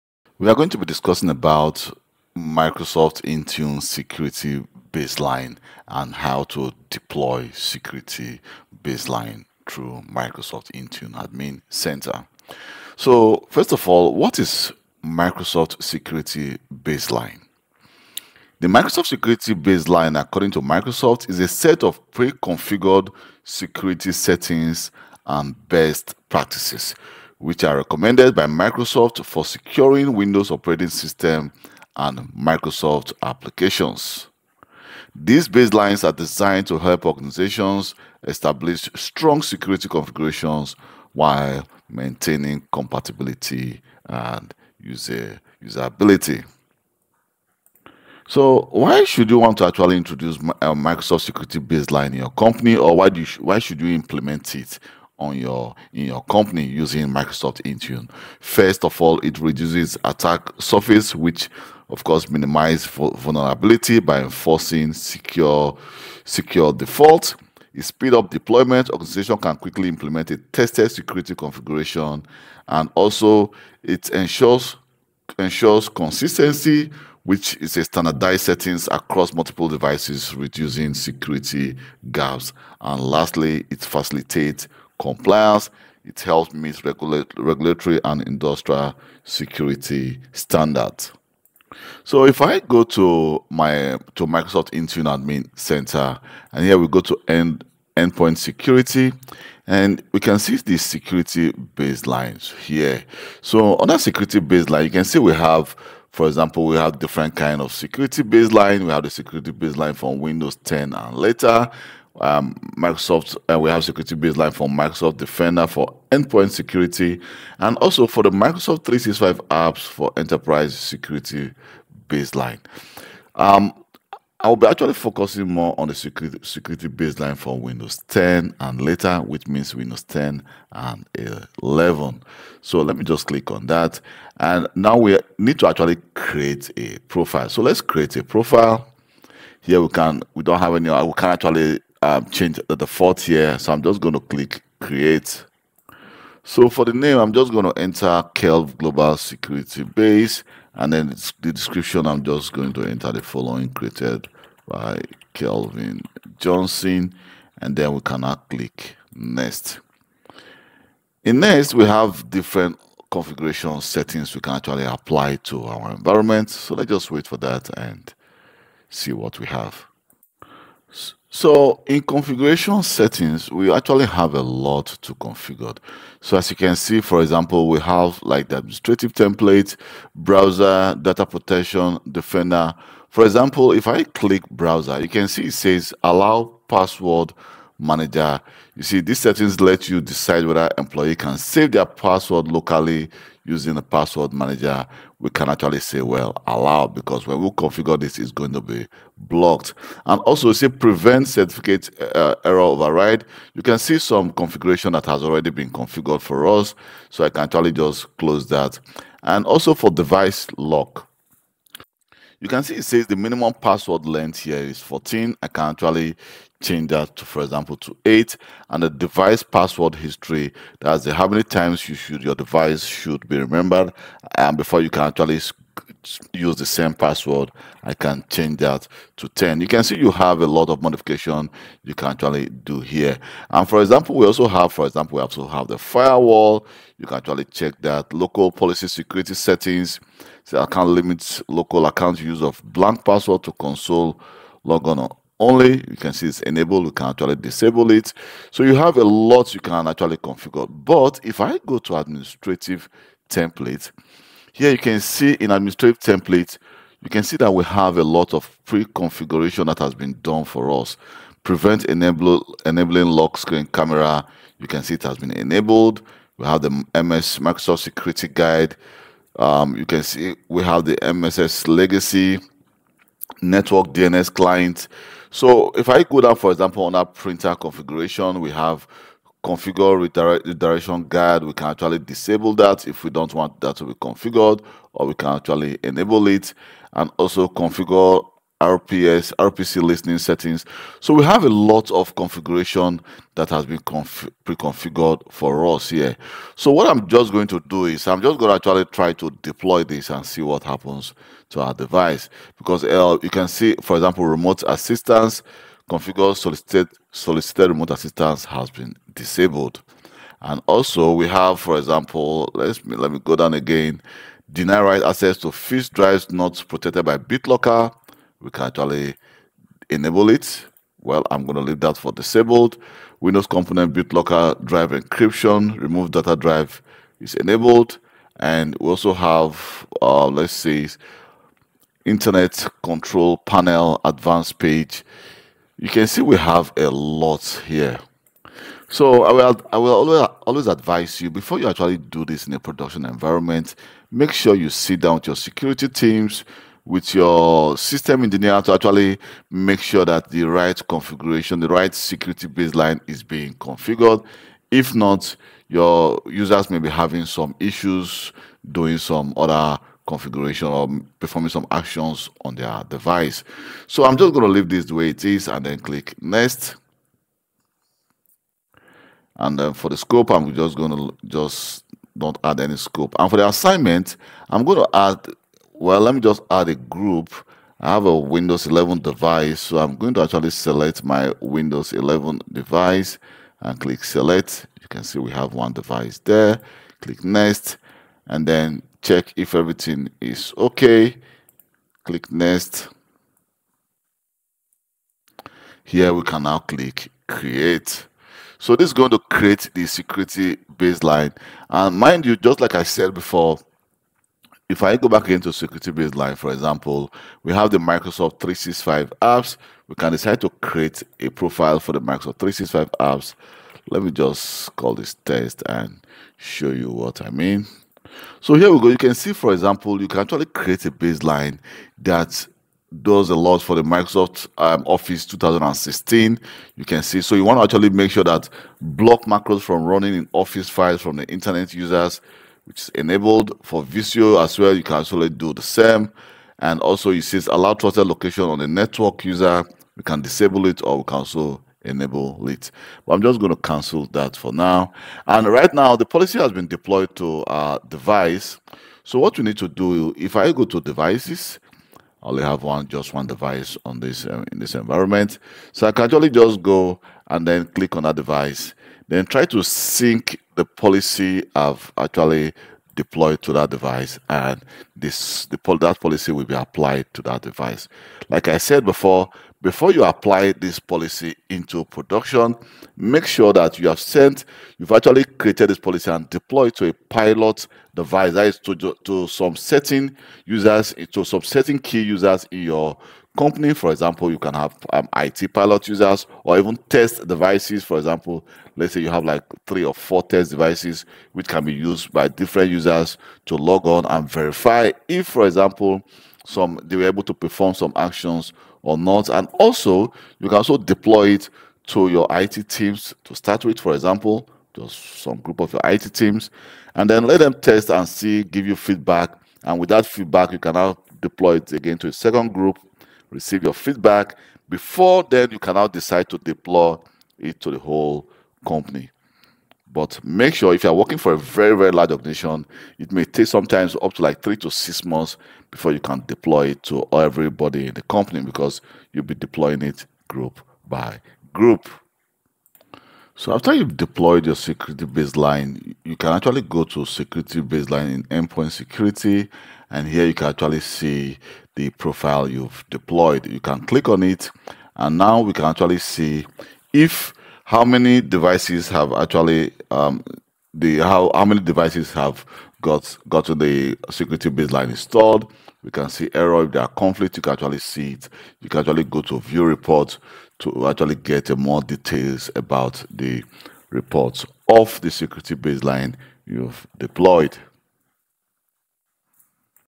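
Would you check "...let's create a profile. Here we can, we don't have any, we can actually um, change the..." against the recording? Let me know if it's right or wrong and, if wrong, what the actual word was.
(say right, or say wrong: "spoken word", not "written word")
right.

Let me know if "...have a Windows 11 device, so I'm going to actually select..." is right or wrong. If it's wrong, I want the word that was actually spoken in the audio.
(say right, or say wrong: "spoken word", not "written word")
right.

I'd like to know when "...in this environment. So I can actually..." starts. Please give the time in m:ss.
7:34.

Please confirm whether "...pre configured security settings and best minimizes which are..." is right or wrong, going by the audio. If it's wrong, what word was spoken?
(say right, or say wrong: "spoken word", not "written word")
wrong: "practices", not "minimizes".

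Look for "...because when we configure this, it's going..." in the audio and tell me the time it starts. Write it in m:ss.
3:16.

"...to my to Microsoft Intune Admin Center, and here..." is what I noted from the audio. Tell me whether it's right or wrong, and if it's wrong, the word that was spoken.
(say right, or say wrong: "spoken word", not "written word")
right.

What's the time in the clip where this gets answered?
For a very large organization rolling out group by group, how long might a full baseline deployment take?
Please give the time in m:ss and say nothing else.
8:44.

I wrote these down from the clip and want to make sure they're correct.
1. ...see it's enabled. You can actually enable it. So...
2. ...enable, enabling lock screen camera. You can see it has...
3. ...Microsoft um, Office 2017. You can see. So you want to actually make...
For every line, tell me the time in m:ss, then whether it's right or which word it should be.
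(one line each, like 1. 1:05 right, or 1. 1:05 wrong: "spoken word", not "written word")
1. 4:06 wrong: "disable", not "enable"
2. 4:21 right
3. 7:03 wrong: "2016", not "2017".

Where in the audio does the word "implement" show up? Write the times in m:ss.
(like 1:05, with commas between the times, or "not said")
0:53, 1:09.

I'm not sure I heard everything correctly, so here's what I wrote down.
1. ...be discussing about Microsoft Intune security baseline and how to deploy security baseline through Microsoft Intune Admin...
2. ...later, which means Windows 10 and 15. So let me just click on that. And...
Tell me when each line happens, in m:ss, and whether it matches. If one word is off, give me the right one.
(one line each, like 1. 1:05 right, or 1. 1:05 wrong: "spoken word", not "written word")
1. 0:00 right
2. 2:08 wrong: "11", not "15".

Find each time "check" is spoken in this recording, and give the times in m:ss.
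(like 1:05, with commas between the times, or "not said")
3:57, 6:29.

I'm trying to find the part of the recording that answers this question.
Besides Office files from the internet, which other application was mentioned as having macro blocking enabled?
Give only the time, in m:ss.
7:13.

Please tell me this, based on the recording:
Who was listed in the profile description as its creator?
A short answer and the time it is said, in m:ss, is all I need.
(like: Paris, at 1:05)
Kelvin Johnson, at 2:35.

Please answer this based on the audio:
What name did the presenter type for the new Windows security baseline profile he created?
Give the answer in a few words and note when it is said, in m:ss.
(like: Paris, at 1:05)
Kelv Global Security Base, at 2:28.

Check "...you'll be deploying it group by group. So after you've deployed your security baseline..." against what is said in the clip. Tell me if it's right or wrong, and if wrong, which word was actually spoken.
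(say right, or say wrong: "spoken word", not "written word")
right.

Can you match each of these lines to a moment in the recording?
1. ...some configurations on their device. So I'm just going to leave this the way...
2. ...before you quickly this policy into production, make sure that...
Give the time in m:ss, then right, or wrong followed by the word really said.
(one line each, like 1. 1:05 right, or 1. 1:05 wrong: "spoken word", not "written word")
1. 6:01 wrong: "actions", not "configurations"
2. 7:49 wrong: "apply", not "quickly".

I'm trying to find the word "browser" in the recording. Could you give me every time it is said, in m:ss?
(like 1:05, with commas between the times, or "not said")
3:00, 3:04.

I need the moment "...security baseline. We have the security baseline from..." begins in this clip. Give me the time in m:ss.
1:47.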